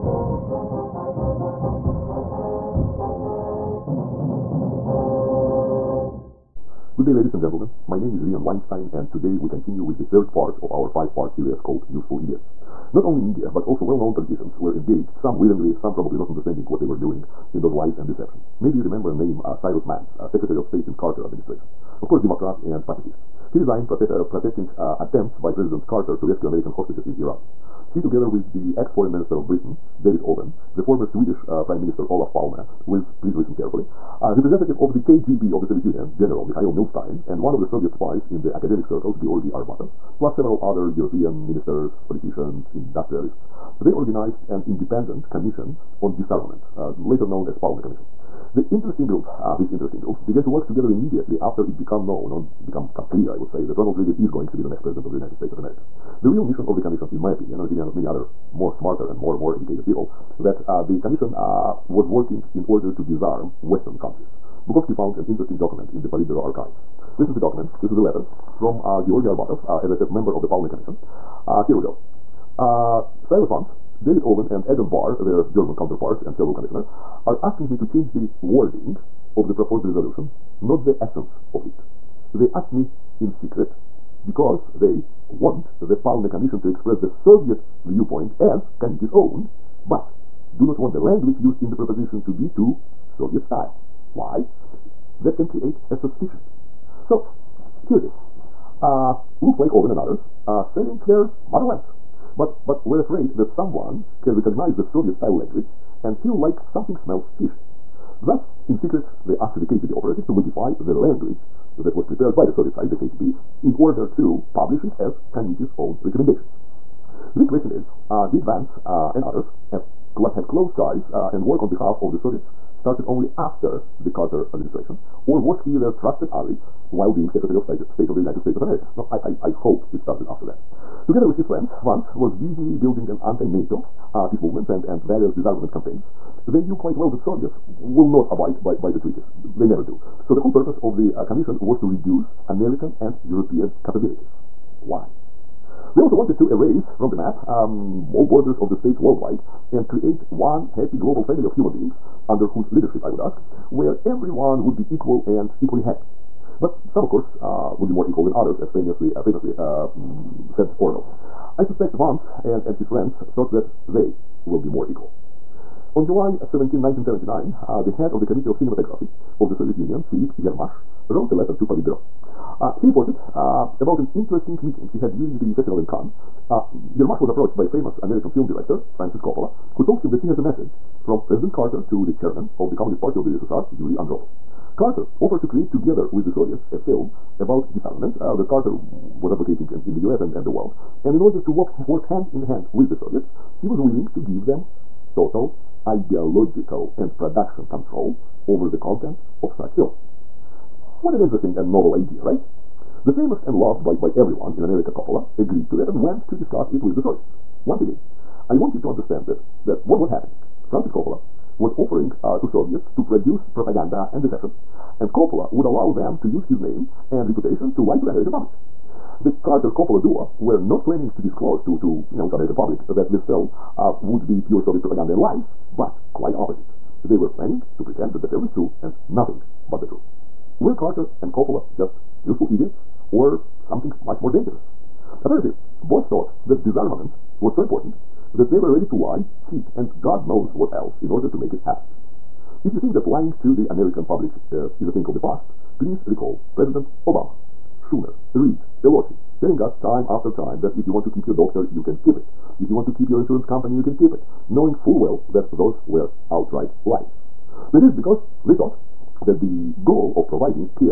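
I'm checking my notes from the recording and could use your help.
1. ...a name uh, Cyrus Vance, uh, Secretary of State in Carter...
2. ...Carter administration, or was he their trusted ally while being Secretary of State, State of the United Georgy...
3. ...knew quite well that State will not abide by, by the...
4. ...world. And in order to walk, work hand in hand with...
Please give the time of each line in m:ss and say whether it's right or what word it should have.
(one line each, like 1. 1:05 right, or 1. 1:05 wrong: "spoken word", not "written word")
1. 0:19 right
2. 2:04 wrong: "States", not "Georgy"
3. 2:16 wrong: "Soviets", not "State"
4. 3:10 right.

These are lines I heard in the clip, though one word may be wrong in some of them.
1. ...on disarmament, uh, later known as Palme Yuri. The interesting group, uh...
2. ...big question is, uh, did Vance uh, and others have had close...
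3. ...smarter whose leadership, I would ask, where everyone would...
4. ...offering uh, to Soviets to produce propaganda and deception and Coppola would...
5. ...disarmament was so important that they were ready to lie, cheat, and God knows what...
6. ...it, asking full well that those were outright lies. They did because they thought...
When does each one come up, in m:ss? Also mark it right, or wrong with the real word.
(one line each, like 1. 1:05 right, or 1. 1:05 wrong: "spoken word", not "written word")
1. 0:46 wrong: "Commission", not "Yuri"
2. 1:57 right
3. 2:32 wrong: "under", not "smarter"
4. 3:31 right
5. 3:56 right
6. 4:14 wrong: "knowing", not "asking".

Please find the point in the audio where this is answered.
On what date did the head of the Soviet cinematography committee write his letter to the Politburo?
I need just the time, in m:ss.
2:46.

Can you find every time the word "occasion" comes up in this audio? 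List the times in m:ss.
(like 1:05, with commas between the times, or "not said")
not said.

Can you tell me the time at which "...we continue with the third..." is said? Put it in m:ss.
0:09.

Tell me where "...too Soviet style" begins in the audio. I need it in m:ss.
1:32.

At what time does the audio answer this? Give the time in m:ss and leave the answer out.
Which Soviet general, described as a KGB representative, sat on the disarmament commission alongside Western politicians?
0:36.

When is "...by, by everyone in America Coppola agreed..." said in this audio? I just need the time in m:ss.
3:23.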